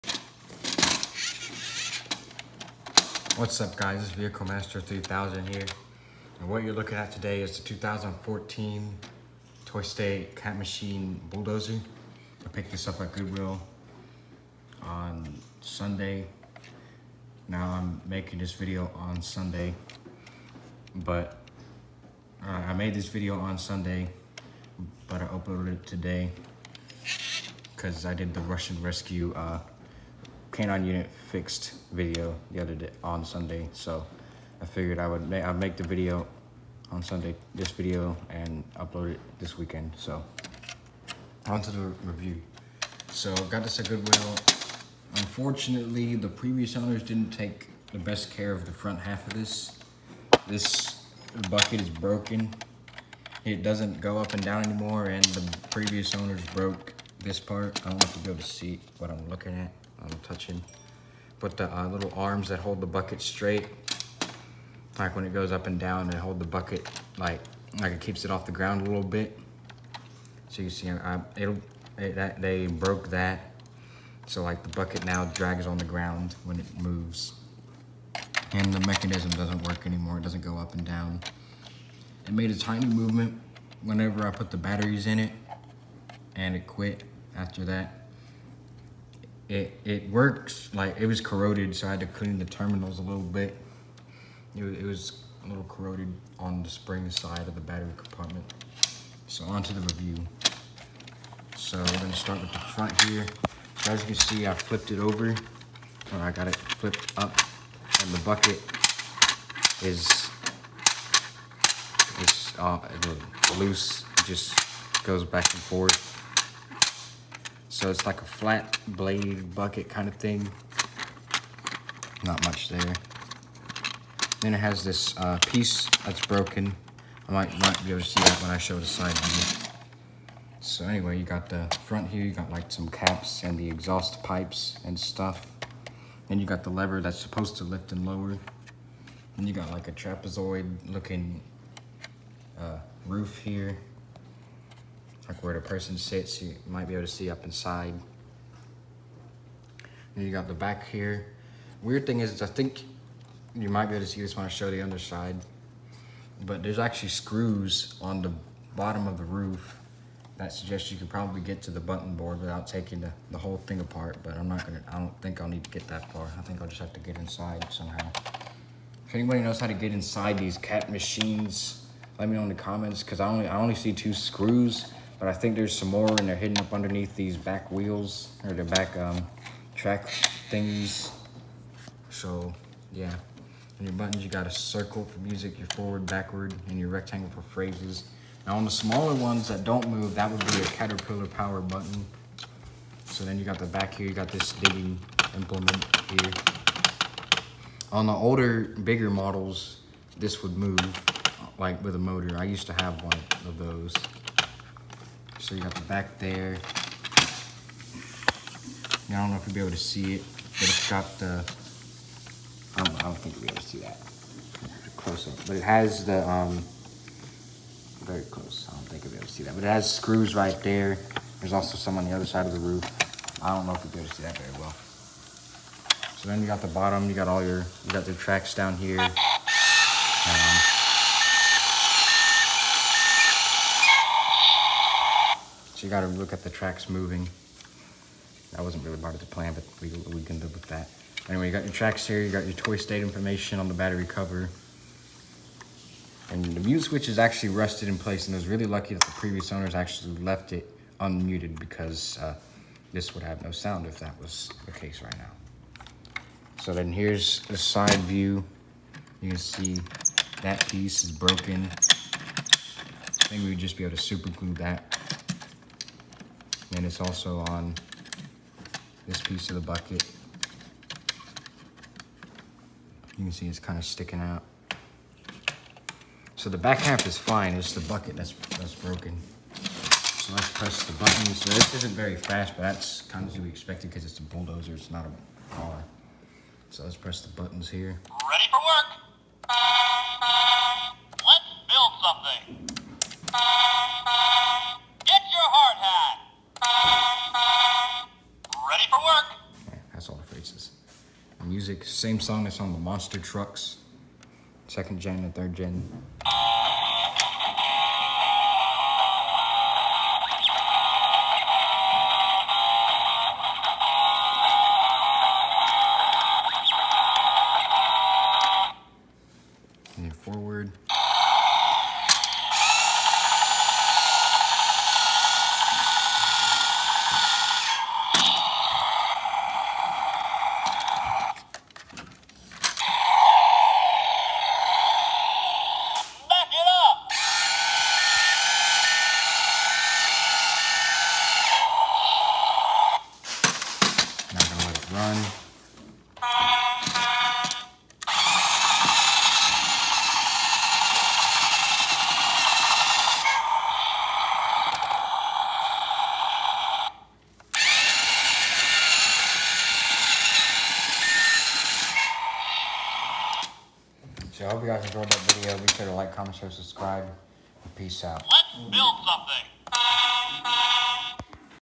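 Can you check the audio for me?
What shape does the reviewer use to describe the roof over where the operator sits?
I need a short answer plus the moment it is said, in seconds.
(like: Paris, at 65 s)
Trapezoid, at 139 s.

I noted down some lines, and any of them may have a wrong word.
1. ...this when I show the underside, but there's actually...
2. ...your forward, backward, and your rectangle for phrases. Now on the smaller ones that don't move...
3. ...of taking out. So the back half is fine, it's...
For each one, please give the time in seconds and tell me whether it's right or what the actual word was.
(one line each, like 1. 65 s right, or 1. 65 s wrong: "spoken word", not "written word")
1. 154 s right
2. 185 s right
3. 273 s wrong: "sticking", not "taking".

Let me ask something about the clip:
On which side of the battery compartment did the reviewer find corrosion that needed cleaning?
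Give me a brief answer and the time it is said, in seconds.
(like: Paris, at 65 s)
Spring side, at 96 s.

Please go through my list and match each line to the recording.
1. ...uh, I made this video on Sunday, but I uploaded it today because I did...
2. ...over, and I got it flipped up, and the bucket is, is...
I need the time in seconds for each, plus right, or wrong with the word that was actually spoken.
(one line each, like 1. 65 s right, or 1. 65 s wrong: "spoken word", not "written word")
1. 22 s right
2. 104 s right.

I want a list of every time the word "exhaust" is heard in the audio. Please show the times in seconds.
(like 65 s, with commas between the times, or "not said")
133 s.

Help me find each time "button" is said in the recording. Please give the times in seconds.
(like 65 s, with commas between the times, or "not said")
161 s, 183 s, 191 s, 280 s, 287 s.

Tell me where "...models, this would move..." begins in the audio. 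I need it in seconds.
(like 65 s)
199 s.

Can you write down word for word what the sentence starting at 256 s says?
So then here's the side view.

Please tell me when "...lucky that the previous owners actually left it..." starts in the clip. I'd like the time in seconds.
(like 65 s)
248 s.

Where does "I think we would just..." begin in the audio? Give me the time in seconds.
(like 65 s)
261 s.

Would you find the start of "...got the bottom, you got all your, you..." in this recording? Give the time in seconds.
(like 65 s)
226 s.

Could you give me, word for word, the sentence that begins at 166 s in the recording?
I think I'll just have to get inside somehow.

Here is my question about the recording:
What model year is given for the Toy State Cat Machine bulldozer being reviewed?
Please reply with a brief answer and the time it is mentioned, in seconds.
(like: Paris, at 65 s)
2014, at 7 s.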